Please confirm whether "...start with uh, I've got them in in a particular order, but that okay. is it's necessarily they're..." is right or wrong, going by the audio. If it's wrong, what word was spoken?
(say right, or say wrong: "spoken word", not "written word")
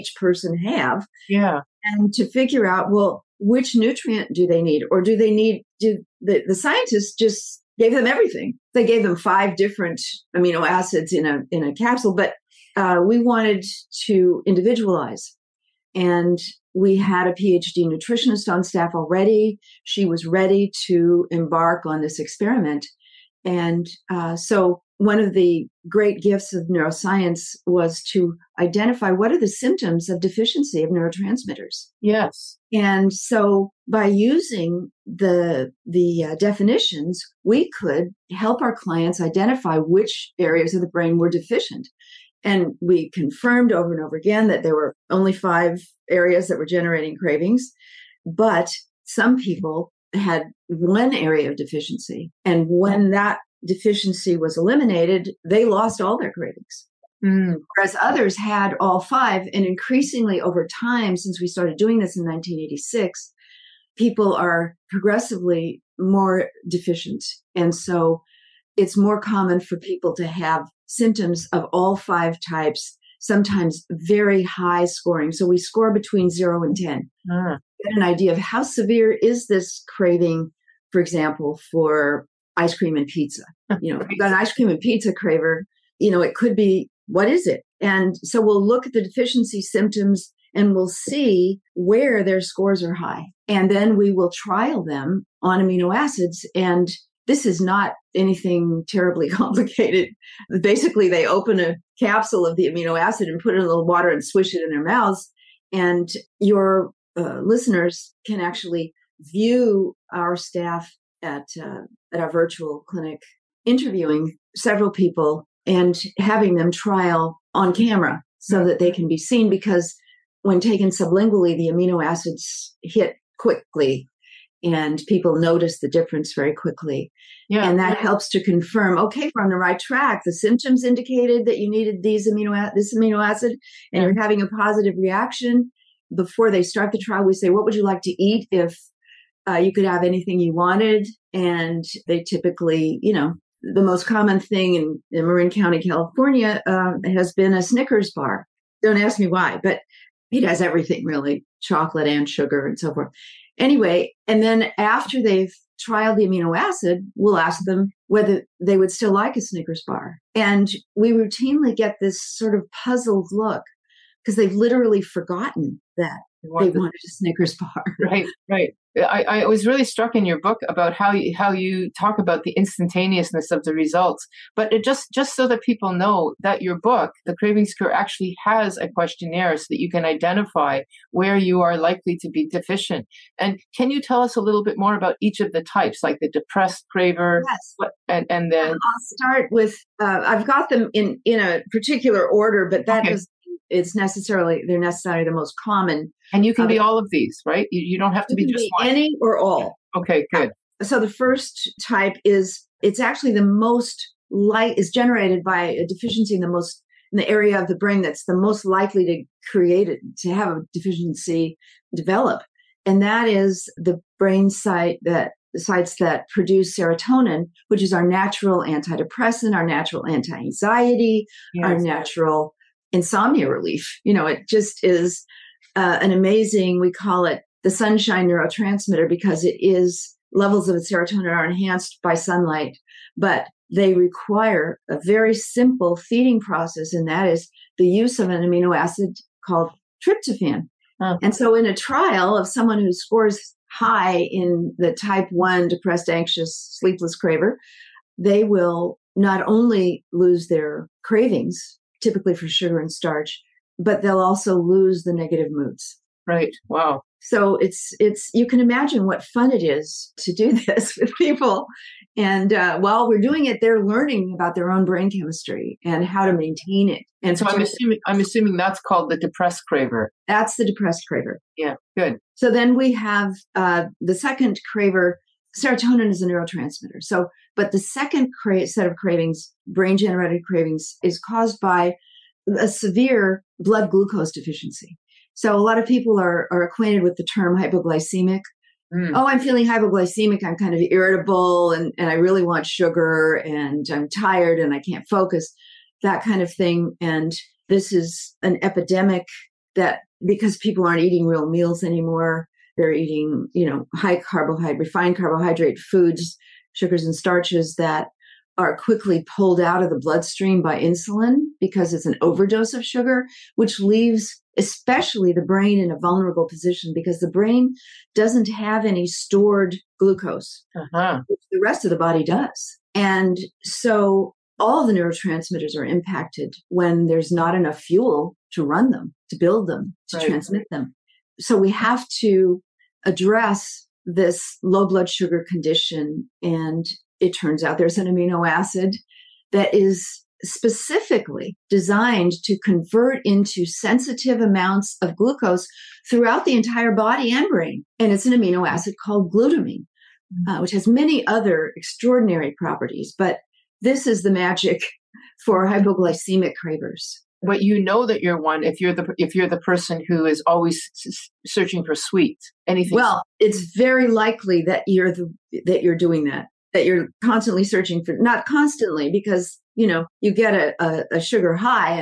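right.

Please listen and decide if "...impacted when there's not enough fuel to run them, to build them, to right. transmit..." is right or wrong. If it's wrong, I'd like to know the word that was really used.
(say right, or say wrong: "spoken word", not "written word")
right.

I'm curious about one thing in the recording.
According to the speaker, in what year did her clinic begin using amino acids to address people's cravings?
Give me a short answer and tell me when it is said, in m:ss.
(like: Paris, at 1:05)
1986, at 1:02.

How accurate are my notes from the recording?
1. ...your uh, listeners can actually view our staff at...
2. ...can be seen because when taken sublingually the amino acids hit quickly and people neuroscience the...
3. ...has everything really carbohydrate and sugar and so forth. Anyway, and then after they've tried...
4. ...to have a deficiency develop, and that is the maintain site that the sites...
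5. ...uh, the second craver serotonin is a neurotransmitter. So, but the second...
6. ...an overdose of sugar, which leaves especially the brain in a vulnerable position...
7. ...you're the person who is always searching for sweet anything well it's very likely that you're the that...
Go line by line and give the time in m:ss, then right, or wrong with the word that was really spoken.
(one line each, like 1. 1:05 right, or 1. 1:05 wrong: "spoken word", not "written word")
1. 1:46 right
2. 1:58 wrong: "notice", not "neuroscience"
3. 2:30 wrong: "chocolate", not "carbohydrate"
4. 3:30 wrong: "brain", not "maintain"
5. 4:33 right
6. 5:12 right
7. 5:59 right.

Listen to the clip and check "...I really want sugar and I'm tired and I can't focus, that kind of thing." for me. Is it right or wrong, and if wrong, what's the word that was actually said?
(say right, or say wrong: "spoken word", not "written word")
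right.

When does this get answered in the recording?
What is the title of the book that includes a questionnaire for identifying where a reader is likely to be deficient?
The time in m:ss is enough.
2:57.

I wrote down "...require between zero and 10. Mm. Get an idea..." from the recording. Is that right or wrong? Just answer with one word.
wrong.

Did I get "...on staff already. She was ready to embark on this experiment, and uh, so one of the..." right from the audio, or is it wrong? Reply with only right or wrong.
right.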